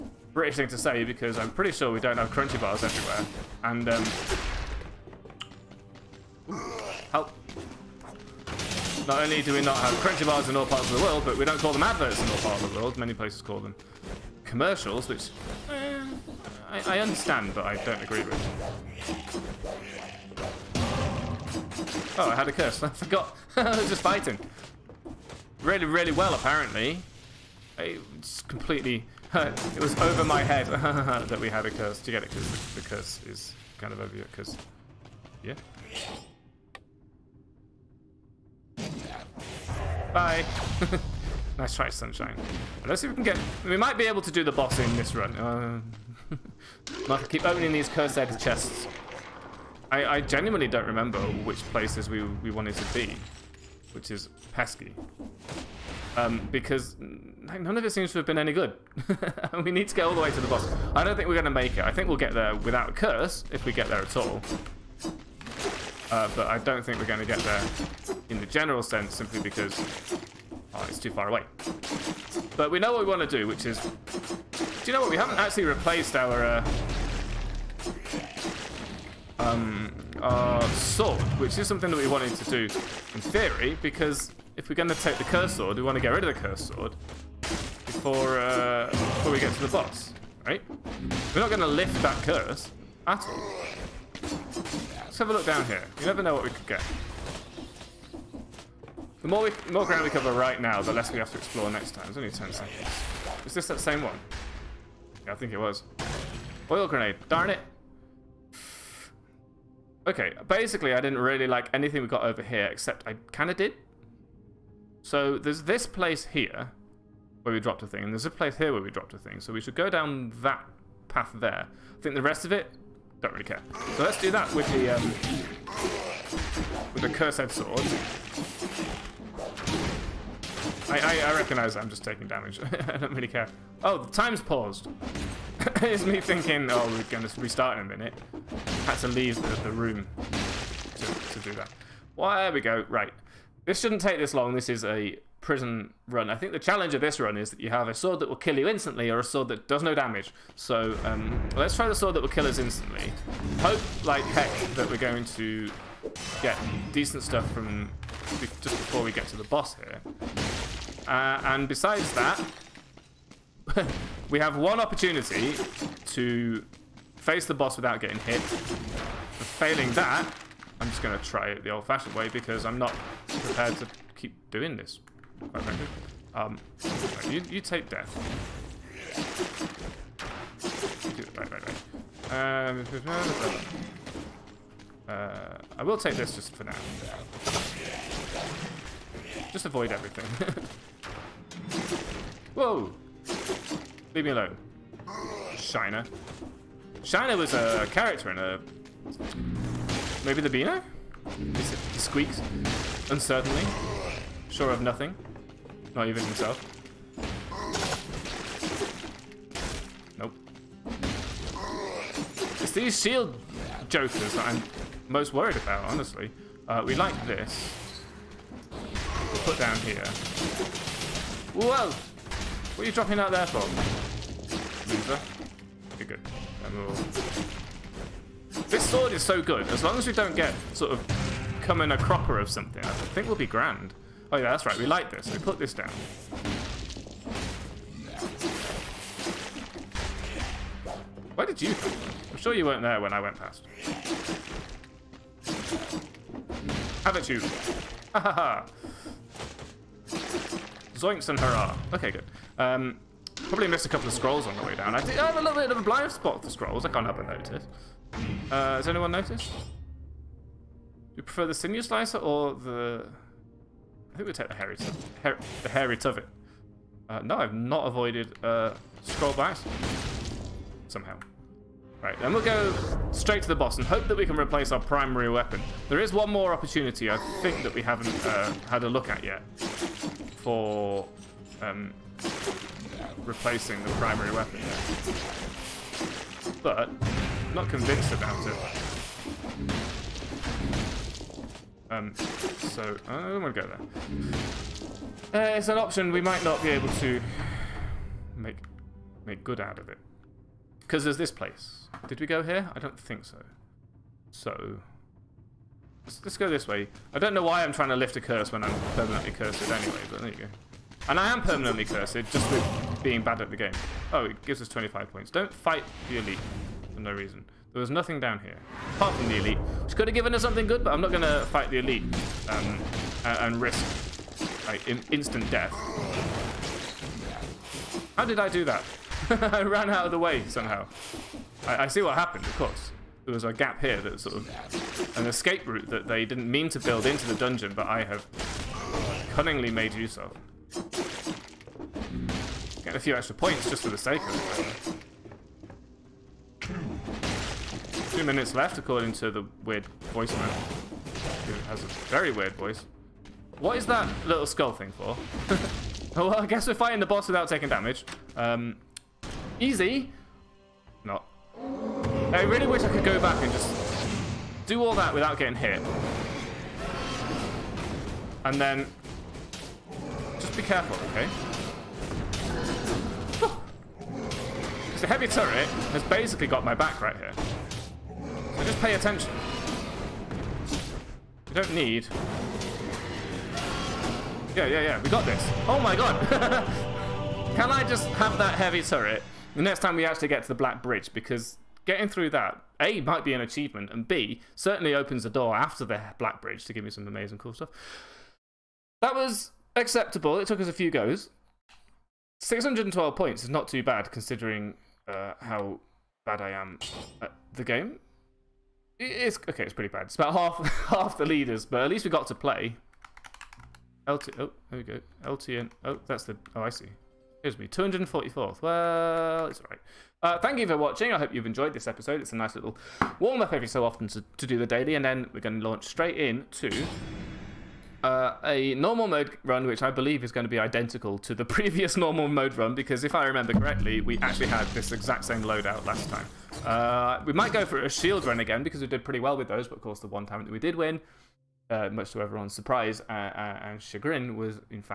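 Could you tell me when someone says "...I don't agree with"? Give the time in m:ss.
0:17.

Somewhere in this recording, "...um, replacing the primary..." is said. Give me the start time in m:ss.
4:41.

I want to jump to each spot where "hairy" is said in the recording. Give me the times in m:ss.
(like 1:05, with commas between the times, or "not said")
4:24.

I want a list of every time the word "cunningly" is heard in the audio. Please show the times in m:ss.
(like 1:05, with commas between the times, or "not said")
5:39.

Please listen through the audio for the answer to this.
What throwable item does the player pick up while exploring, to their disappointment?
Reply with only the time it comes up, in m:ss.
1:46.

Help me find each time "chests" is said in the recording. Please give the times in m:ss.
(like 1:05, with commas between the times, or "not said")
0:48.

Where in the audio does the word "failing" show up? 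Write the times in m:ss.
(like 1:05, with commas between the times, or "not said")
2:49.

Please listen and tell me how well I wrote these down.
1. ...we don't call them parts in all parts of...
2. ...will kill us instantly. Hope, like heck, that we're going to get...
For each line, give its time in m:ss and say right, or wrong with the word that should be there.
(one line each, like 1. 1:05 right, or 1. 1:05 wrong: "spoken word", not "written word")
1. 0:11 wrong: "adverts", not "parts"
2. 2:32 right.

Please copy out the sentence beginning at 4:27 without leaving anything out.
Uh, no, I've not avoided uh, scroll bites.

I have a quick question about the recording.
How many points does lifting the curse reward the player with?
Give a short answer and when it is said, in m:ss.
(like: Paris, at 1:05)
25, at 5:14.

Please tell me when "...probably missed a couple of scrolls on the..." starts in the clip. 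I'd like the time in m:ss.
4:13.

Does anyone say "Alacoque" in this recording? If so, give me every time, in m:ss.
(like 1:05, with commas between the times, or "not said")
not said.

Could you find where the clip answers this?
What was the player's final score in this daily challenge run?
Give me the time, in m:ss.
6:42.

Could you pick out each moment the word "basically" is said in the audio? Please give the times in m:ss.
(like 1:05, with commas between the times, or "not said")
1:50, 6:16.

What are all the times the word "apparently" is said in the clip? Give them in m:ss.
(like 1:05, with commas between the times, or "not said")
0:26.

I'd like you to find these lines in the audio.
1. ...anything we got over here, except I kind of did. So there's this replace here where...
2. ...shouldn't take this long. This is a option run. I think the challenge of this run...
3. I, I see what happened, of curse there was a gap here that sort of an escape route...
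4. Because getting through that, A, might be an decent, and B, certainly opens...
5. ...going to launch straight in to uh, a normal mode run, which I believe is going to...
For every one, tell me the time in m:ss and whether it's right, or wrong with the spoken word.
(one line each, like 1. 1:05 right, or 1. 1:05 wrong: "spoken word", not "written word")
1. 1:51 wrong: "place", not "replace"
2. 2:23 wrong: "prison", not "option"
3. 5:31 wrong: "course", not "curse"
4. 6:31 wrong: "achievement", not "decent"
5. 7:05 right.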